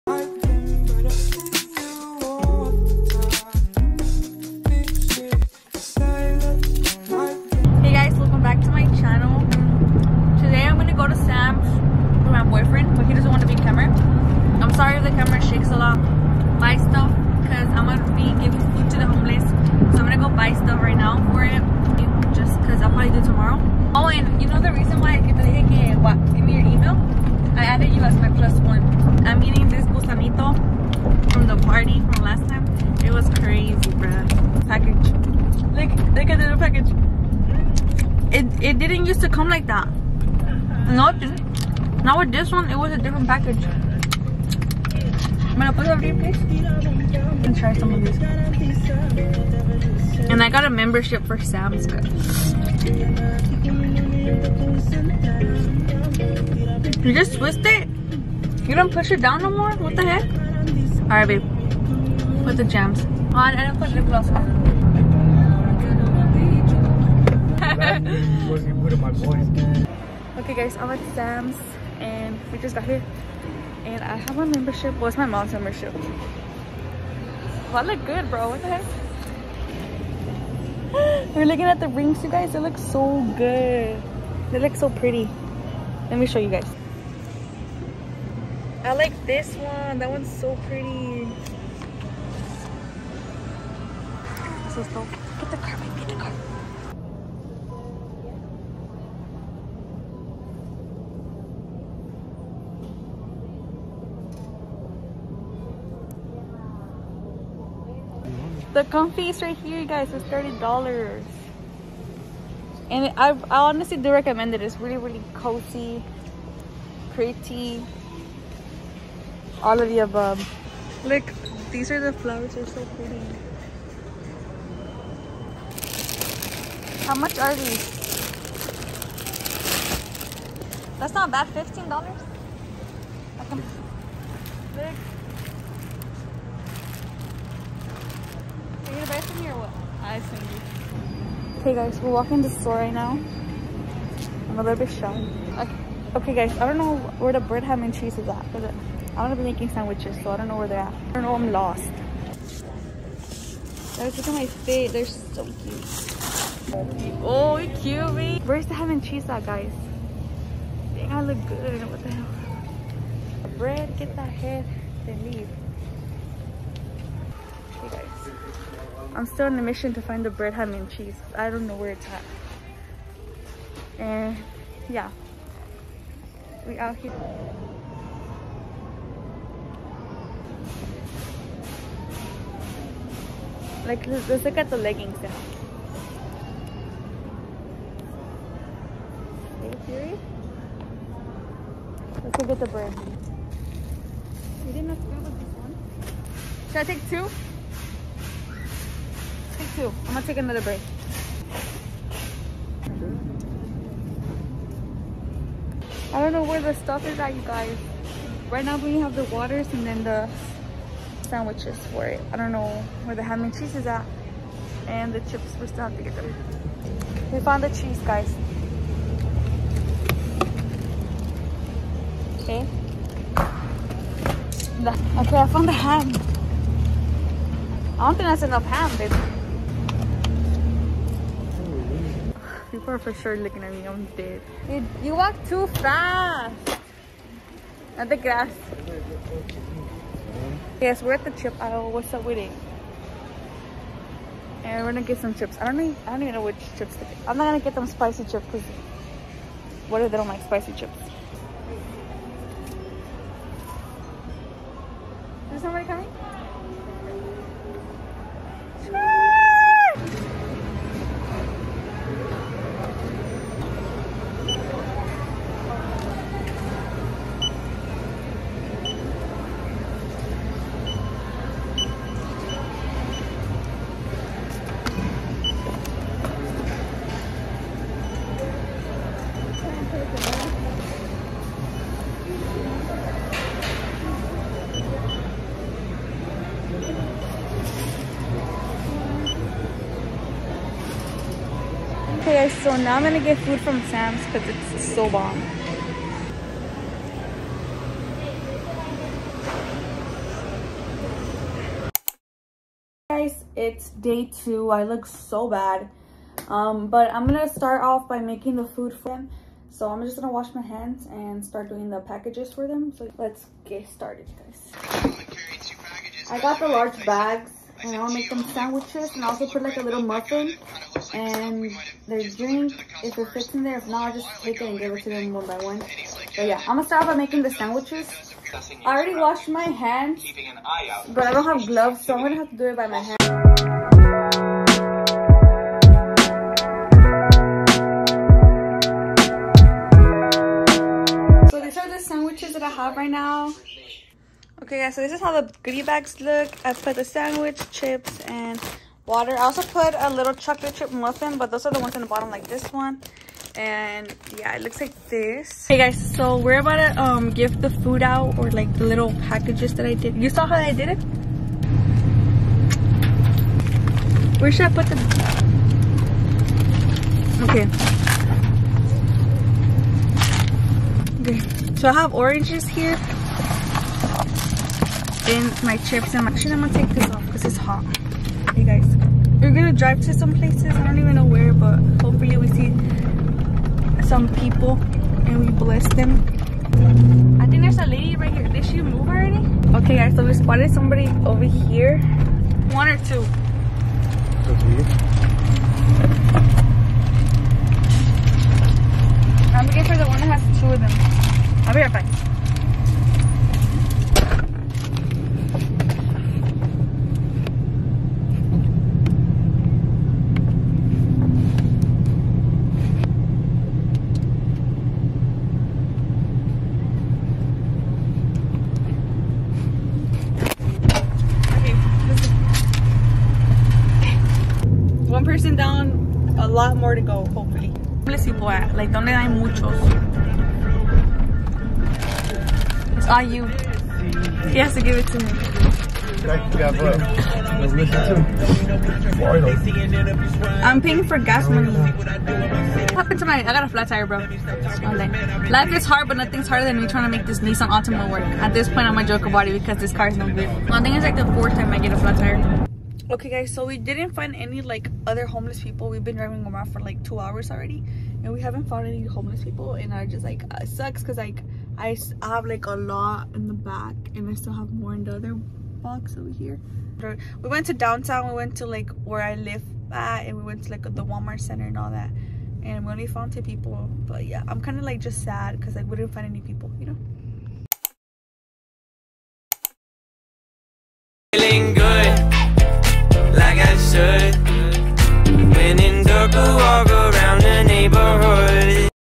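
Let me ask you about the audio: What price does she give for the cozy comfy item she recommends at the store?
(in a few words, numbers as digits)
$30.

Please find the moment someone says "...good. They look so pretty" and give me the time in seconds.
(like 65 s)
83 s.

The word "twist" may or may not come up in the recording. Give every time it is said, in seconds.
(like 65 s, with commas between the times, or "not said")
57 s.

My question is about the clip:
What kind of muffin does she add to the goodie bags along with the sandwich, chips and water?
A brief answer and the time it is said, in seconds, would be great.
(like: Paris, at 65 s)
chocolate chip, at 350 s.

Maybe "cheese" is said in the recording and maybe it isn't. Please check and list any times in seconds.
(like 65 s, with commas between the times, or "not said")
147 s, 159 s, 170 s, 213 s, 217 s.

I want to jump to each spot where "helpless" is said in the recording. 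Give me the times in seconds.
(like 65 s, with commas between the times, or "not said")
not said.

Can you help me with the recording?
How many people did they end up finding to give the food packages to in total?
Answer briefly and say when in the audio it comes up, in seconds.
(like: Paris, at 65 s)
2, at 473 s.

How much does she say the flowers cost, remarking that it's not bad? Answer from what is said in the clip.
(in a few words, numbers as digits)
$15.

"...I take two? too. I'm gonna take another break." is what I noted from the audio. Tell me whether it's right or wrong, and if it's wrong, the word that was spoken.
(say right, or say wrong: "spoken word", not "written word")
right.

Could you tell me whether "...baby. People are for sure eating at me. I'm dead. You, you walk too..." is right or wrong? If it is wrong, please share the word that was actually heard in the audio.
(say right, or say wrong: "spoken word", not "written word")
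wrong: "looking", not "eating".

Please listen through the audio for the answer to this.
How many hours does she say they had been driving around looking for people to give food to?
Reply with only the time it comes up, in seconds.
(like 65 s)
457 s.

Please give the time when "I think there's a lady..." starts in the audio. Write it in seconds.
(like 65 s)
387 s.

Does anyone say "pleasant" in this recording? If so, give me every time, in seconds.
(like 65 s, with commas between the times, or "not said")
not said.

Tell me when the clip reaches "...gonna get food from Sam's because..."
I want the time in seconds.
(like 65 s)
293 s.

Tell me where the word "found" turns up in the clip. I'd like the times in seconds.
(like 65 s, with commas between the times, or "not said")
217 s, 225 s, 458 s, 473 s.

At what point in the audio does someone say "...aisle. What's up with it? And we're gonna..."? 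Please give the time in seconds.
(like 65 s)
241 s.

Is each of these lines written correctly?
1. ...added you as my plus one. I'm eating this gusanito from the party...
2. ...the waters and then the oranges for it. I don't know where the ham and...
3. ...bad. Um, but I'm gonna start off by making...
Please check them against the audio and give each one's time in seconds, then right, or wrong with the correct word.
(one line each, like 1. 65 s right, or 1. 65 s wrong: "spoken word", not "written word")
1. 27 s right
2. 209 s wrong: "sandwiches", not "oranges"
3. 305 s right.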